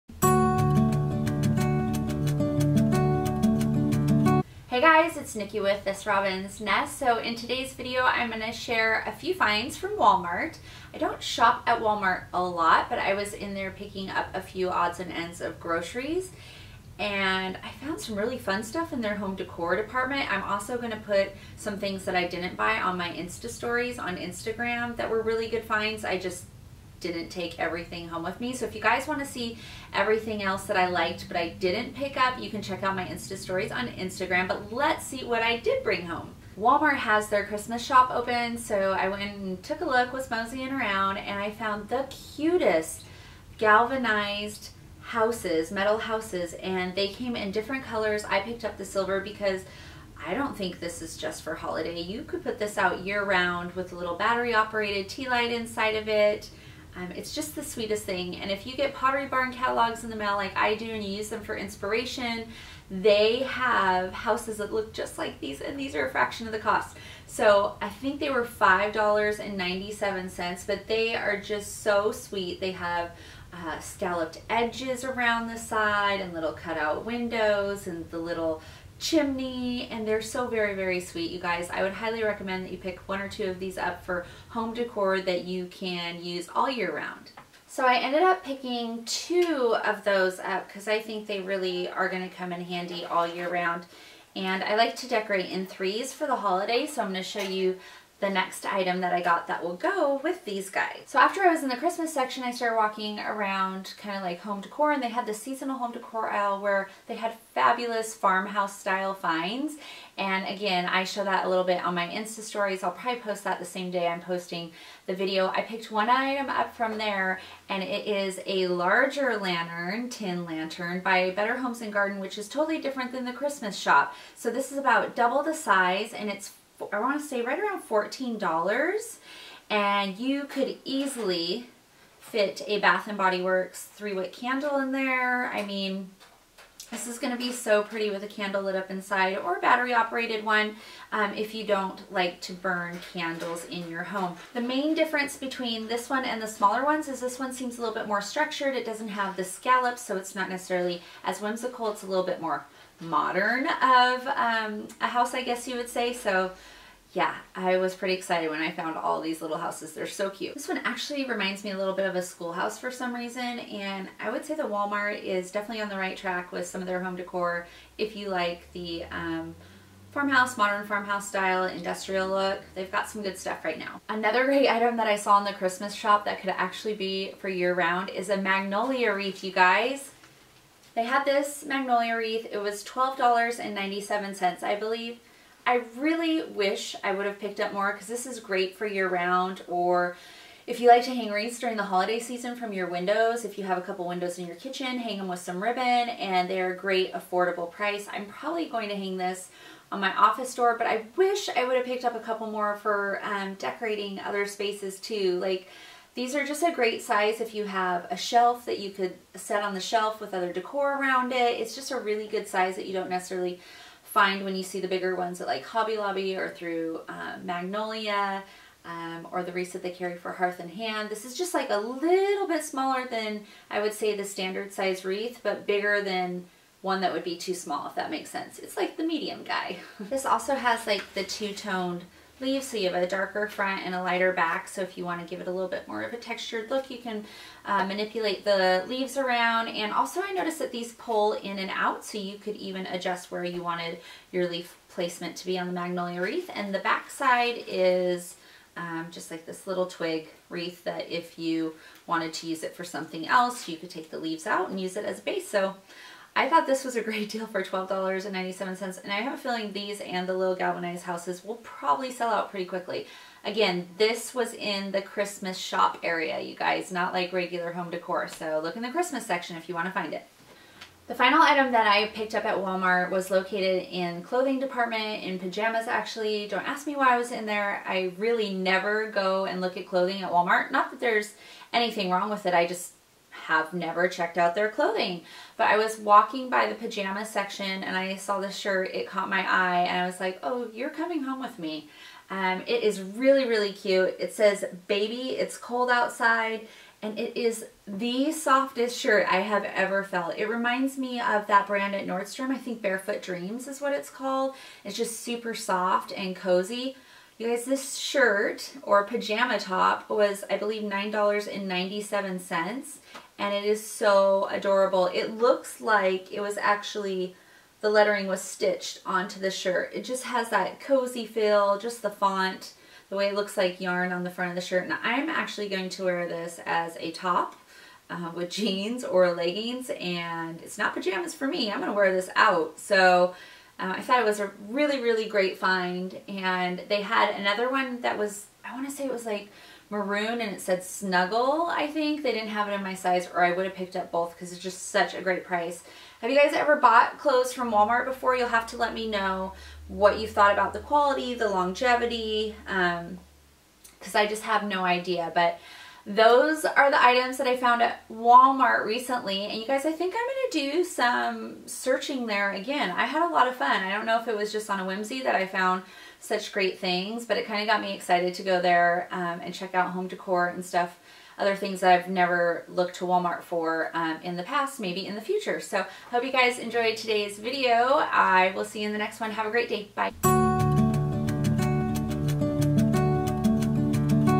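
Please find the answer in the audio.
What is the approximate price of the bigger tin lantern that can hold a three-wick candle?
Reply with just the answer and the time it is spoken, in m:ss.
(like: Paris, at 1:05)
$14, at 2:07.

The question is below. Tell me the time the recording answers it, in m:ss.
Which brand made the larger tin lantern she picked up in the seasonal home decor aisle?
2:01.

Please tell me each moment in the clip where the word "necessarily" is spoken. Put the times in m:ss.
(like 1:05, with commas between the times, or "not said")
2:30, 3:33.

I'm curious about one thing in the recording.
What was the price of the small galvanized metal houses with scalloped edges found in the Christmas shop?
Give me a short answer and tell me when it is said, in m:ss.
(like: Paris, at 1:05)
$5.97, at 1:08.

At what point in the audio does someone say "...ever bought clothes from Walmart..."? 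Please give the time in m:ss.
5:46.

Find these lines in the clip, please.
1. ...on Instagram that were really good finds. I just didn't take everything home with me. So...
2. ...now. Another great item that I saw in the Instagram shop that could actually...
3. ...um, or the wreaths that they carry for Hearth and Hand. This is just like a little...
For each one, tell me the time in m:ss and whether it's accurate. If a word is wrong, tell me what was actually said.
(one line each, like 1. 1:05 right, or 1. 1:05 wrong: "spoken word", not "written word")
1. 0:23 right
2. 2:53 wrong: "Christmas", not "Instagram"
3. 3:38 right.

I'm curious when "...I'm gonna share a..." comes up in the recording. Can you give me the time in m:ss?
0:08.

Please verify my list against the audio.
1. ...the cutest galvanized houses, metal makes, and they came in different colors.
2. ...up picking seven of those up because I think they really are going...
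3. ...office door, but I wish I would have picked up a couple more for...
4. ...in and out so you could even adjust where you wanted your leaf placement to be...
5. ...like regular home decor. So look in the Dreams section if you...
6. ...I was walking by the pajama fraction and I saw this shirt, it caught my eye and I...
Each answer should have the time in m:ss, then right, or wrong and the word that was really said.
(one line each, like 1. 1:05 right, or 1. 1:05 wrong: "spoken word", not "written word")
1. 0:41 wrong: "houses", not "makes"
2. 1:28 wrong: "two", not "seven"
3. 3:20 right
4. 4:01 right
5. 4:27 wrong: "Christmas", not "Dreams"
6. 4:45 wrong: "section", not "fraction".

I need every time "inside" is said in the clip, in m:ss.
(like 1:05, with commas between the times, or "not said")
0:55, 2:18.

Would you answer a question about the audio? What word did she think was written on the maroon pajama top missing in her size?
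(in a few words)
Snuggle.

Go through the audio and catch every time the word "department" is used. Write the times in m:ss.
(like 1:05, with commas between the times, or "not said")
0:19, 4:34.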